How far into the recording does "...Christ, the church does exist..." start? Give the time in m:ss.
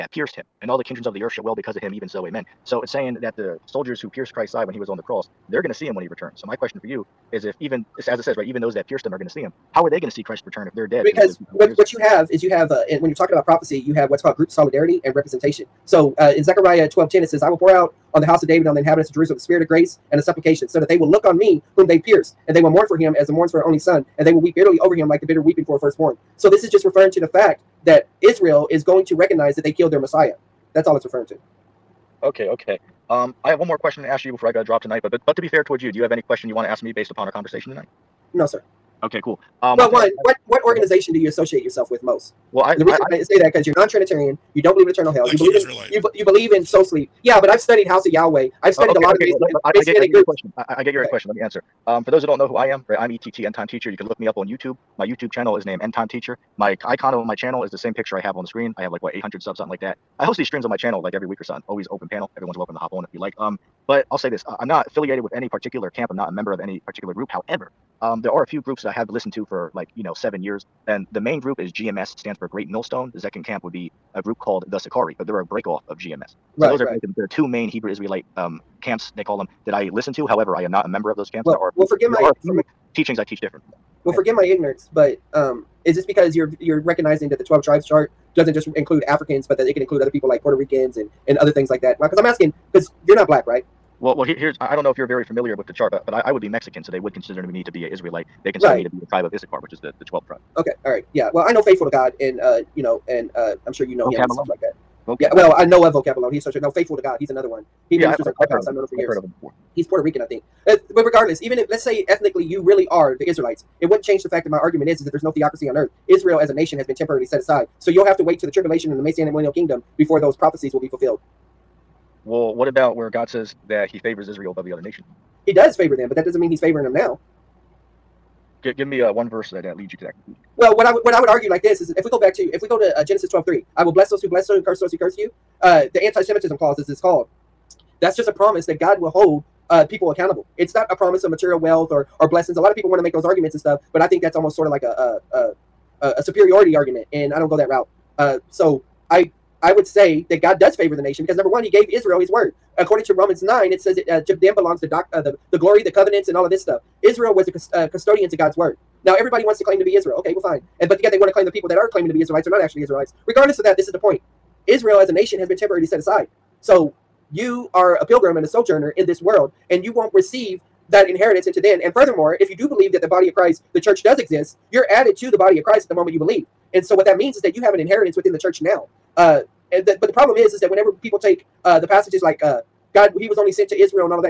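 2:53.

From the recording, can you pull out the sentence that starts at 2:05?
He does favor them, but that doesn't mean he's favoring them now.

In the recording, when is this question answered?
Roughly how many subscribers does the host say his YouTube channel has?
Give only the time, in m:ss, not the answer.
0:59.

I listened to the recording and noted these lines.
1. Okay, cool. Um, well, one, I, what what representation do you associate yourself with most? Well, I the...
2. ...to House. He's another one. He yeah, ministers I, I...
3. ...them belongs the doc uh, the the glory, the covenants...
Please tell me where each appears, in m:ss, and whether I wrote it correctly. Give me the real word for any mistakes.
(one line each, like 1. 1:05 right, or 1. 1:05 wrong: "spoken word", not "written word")
1. 0:39 wrong: "organization", not "representation"
2. 1:46 wrong: "God", not "House"
3. 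2:34 right.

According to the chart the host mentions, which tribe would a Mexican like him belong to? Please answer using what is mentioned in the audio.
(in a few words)
Issachar.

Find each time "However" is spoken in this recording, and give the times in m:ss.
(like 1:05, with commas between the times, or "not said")
1:07, 1:20.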